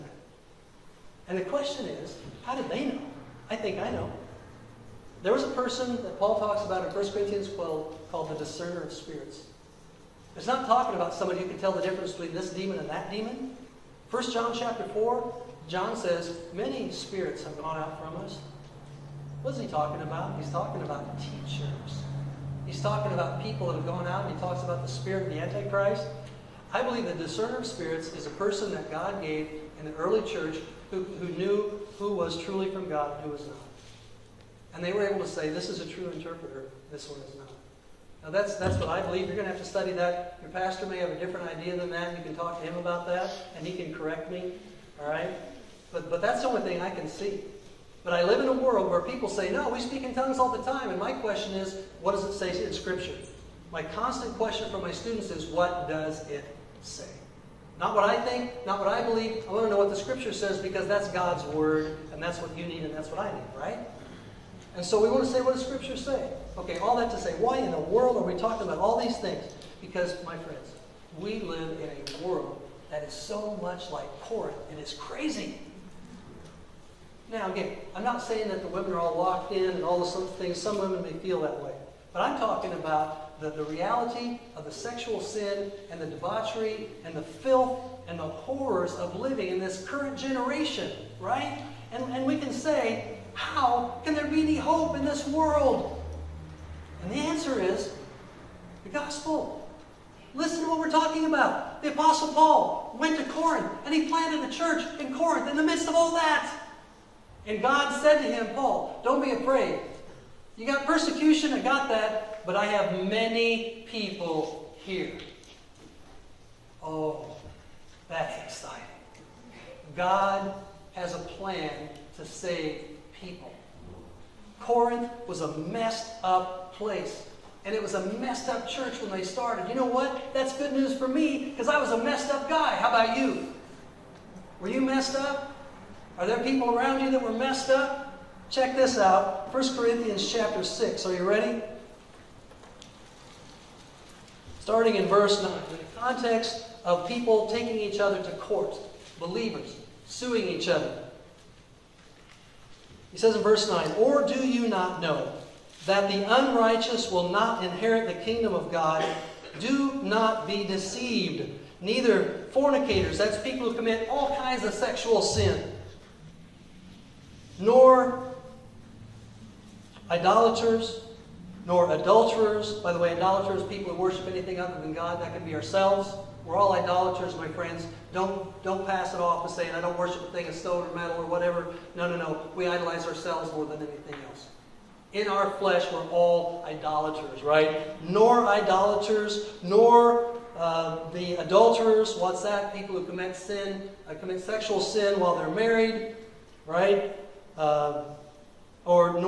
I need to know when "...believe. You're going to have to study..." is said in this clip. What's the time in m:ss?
0:39.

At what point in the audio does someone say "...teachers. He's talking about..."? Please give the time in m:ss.
0:21.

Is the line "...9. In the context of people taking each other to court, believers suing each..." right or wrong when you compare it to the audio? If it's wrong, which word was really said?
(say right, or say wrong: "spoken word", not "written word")
right.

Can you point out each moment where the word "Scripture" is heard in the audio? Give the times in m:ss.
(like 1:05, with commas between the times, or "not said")
0:52, 0:59, 1:05.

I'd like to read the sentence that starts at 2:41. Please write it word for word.
Neither fornicators, that's people who commit all kinds of sexual sin, nor idolaters, nor adulterers.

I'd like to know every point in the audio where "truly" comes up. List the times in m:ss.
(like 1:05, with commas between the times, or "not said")
0:32.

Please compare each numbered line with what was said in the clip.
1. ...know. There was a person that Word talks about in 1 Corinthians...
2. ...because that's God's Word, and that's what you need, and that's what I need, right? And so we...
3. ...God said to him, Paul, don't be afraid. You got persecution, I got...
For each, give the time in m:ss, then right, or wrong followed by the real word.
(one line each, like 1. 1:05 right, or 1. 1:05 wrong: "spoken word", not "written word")
1. 0:03 wrong: "Paul", not "Word"
2. 1:00 right
3. 1:47 right.